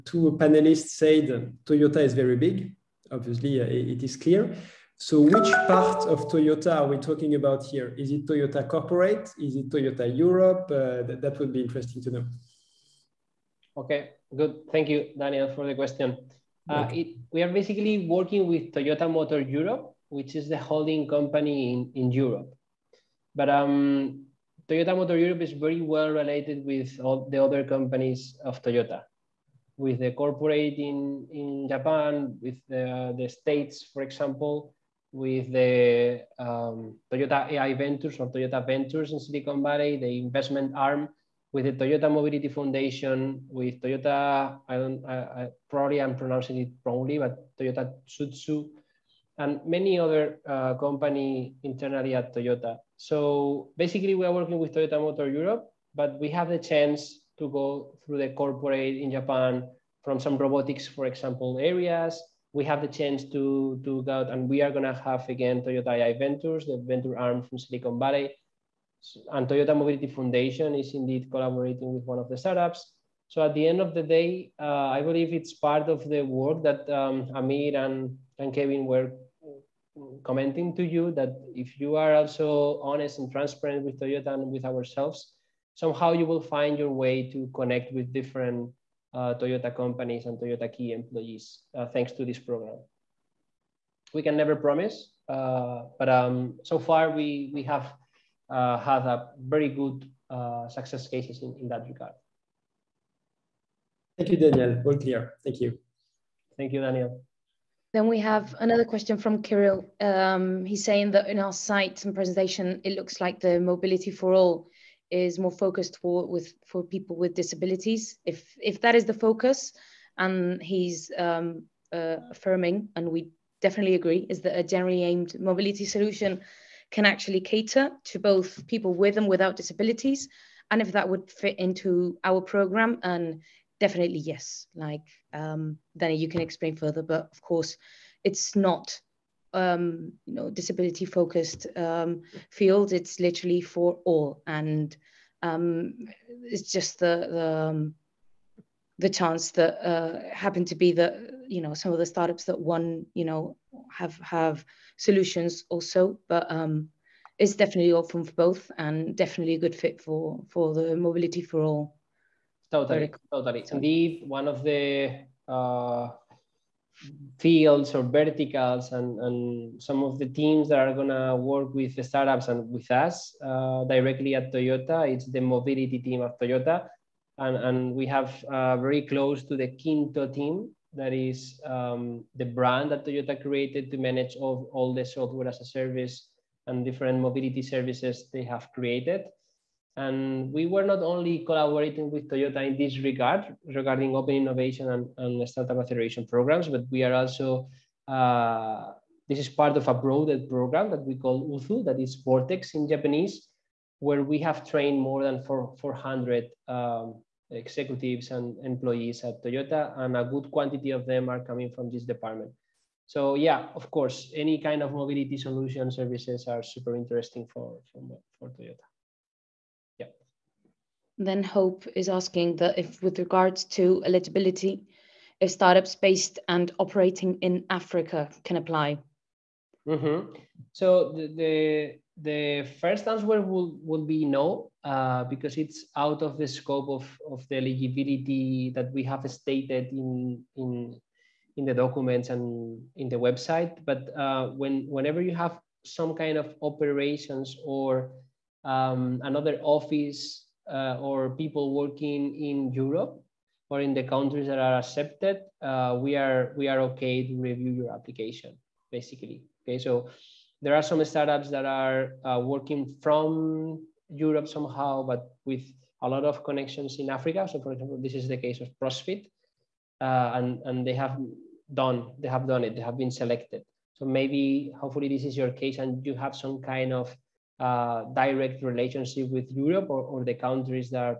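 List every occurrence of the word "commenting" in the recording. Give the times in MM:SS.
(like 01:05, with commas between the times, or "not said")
01:20.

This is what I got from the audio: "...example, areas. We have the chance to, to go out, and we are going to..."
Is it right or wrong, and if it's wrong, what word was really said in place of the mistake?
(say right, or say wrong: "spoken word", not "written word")
right.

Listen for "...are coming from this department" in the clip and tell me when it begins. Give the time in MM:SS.
03:31.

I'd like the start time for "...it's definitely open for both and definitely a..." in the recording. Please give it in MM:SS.
02:37.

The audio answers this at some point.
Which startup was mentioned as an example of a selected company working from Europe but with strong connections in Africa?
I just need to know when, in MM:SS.
04:28.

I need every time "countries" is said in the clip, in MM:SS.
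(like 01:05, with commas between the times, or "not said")
04:14, 04:40.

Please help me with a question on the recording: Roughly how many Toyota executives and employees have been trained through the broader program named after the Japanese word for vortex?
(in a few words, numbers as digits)
400.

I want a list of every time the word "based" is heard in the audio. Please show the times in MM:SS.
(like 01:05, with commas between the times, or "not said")
03:45.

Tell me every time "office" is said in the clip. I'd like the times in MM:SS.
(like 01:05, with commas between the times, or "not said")
04:09.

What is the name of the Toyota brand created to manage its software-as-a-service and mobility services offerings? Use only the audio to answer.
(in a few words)
Kinto.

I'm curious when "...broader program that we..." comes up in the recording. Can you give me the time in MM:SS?
03:19.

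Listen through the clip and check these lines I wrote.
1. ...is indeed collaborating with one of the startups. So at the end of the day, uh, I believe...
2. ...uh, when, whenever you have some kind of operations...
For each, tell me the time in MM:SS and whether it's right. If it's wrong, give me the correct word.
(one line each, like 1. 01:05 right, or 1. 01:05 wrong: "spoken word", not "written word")
1. 01:10 right
2. 04:04 right.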